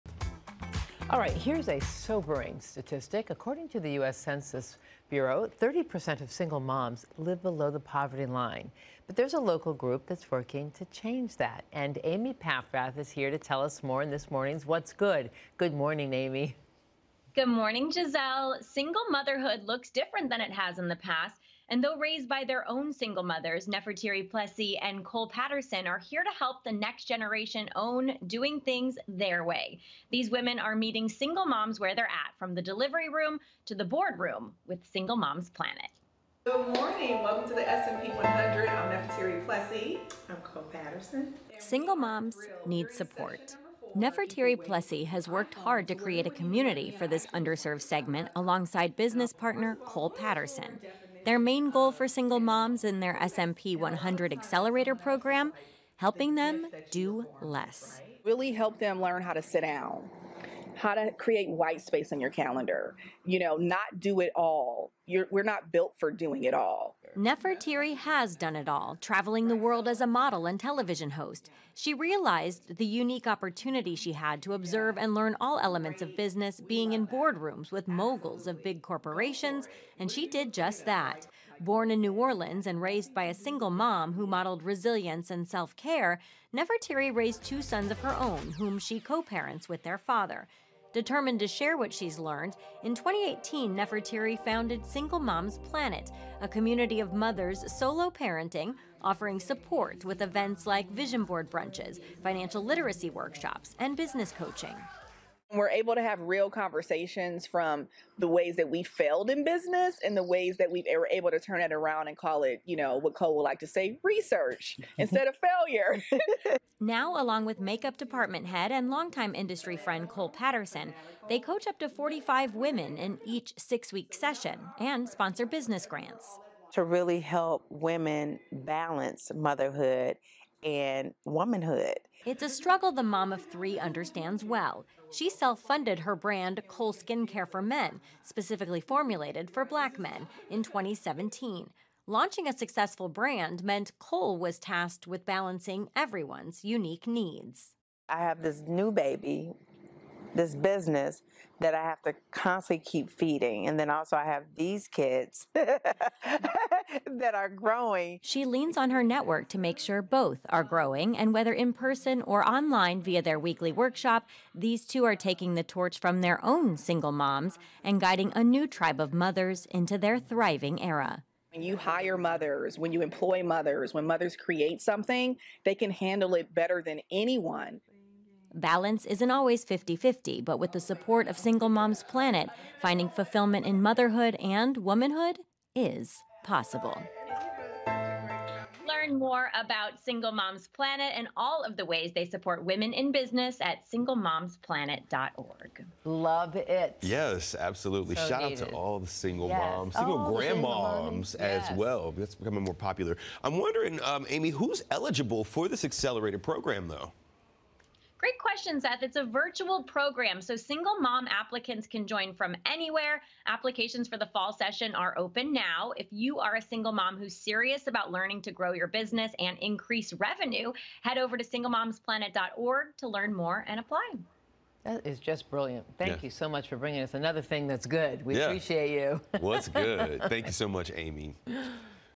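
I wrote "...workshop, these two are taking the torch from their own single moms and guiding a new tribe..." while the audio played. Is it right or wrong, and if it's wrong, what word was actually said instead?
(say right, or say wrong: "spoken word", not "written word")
right.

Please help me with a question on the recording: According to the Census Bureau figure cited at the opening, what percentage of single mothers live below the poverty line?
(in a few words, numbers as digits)
30%.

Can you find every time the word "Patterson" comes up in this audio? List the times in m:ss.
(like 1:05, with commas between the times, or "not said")
0:25, 0:40, 0:50, 2:00.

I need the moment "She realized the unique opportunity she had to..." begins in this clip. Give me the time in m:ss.
1:11.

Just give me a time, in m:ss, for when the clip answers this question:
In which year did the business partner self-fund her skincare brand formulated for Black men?
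2:20.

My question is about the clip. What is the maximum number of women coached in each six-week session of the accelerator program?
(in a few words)
45.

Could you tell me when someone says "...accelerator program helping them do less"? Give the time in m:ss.
0:54.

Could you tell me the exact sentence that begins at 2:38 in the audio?
She leans on her network to make sure both are growing.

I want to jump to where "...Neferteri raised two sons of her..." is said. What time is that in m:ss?
1:26.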